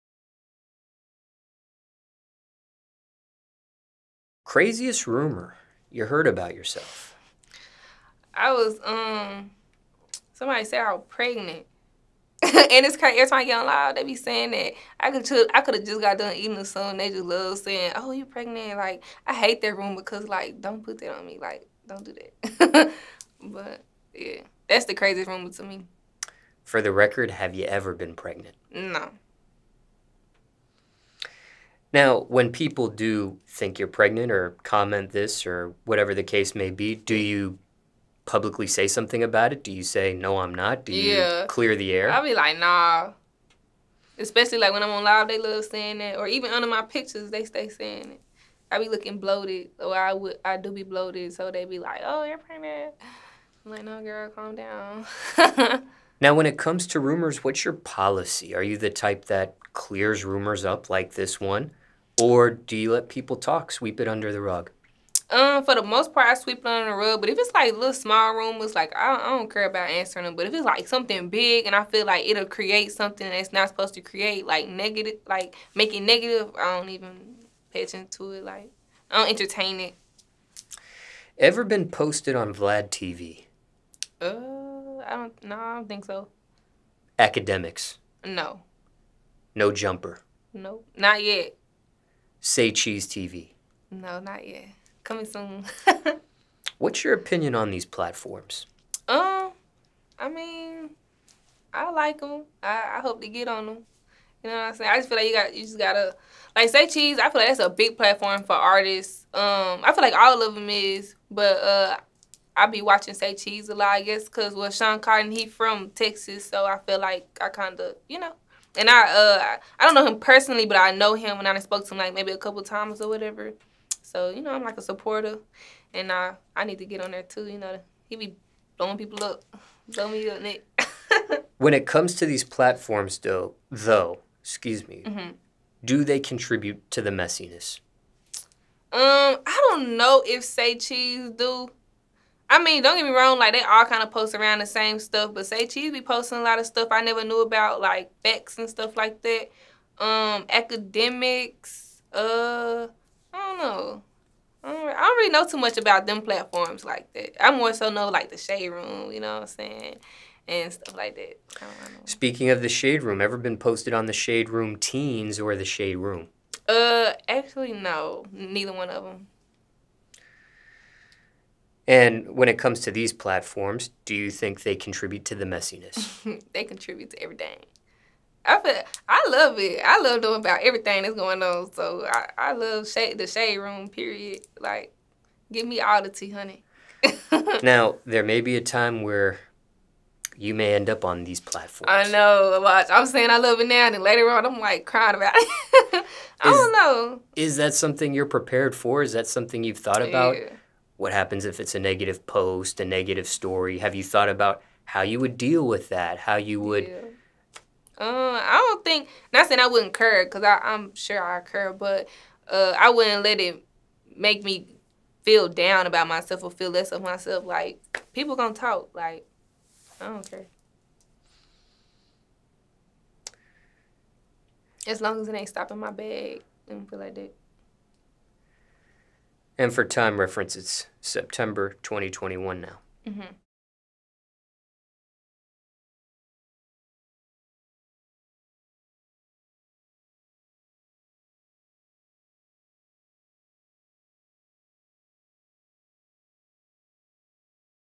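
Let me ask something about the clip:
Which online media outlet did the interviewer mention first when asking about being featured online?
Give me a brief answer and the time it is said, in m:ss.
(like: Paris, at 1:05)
Vlad TV, at 1:22.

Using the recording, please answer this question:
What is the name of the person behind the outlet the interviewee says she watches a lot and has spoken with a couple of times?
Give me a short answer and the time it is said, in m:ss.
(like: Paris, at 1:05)
Shawn Cotton, at 1:54.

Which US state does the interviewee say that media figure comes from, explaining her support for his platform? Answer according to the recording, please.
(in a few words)
Texas.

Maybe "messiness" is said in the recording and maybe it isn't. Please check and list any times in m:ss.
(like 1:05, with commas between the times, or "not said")
2:17, 2:55.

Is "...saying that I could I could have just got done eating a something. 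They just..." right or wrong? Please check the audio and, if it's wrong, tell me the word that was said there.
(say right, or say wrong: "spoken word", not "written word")
right.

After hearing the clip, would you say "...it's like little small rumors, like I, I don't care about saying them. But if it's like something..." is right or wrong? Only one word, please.
wrong.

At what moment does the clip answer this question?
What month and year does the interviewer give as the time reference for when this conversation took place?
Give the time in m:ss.
3:51.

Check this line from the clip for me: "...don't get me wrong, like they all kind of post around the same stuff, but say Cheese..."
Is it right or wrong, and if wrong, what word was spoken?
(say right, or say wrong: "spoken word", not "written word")
right.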